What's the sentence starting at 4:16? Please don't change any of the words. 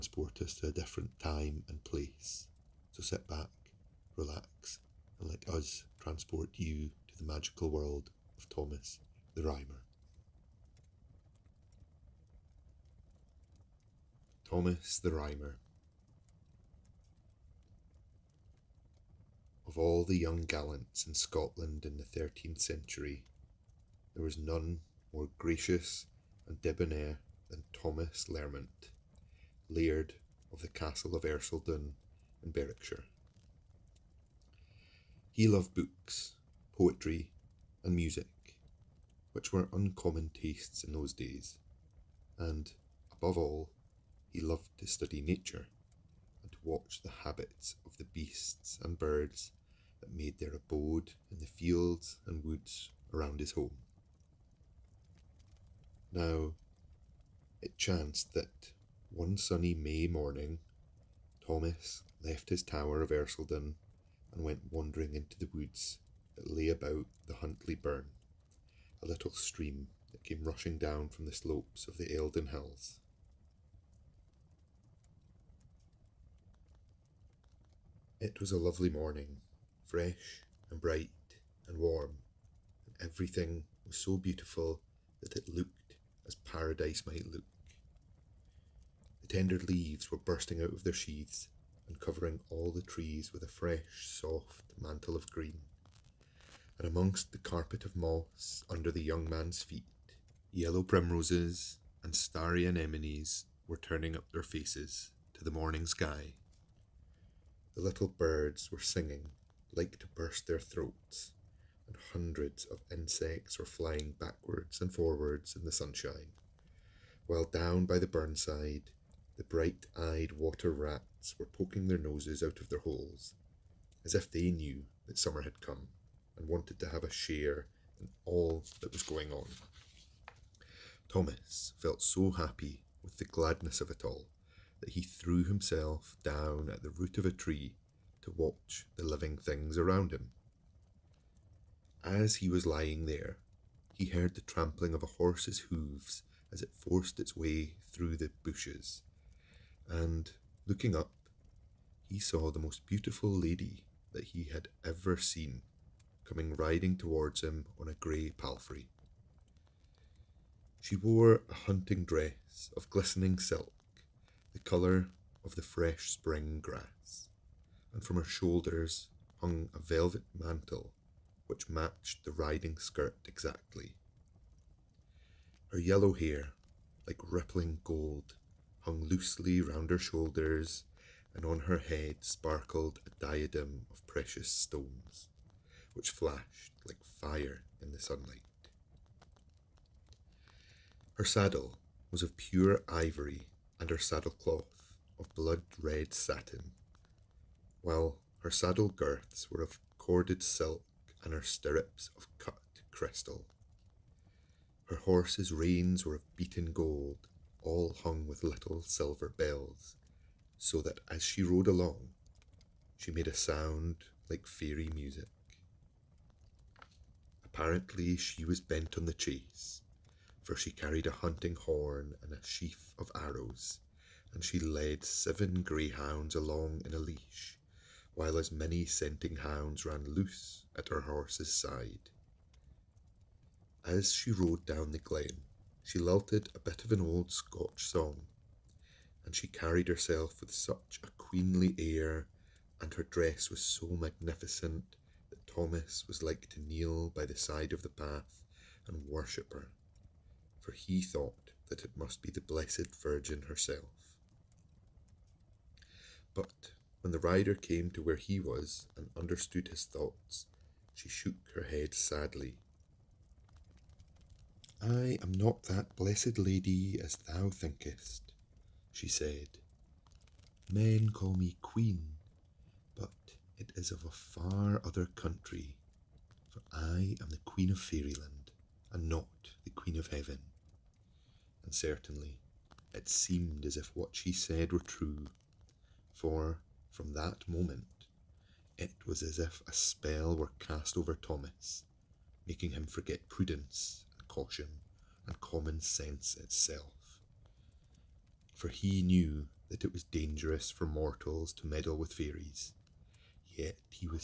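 But when the rider came to where he was and understood his thoughts, she shook her head sadly.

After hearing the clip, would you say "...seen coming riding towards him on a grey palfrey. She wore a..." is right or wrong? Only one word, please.
right.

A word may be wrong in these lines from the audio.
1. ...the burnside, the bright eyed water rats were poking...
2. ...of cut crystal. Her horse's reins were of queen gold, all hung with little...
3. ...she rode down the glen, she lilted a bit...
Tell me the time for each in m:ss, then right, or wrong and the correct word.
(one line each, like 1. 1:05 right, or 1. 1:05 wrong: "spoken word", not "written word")
1. 1:57 right
2. 3:22 wrong: "beaten", not "queen"
3. 3:54 right.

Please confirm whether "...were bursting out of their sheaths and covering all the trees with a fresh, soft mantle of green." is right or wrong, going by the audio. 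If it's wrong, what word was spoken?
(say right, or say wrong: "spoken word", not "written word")
right.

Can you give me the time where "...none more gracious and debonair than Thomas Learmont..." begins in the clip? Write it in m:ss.
0:24.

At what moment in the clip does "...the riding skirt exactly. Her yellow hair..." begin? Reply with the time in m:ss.
2:52.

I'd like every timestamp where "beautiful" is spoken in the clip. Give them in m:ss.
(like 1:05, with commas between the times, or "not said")
1:24, 2:32.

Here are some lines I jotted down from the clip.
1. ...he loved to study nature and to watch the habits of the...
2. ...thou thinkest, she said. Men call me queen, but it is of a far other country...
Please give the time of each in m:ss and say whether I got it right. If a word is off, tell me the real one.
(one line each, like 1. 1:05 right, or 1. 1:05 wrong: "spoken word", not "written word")
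1. 0:44 right
2. 4:27 right.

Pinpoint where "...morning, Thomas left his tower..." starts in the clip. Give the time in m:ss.
1:00.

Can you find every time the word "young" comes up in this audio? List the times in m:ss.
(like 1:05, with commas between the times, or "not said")
0:20, 1:39.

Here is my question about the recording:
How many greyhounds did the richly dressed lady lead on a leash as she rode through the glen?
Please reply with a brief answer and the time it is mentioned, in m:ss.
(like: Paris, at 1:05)
7, at 3:45.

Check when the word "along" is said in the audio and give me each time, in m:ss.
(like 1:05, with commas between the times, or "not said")
3:31, 3:46.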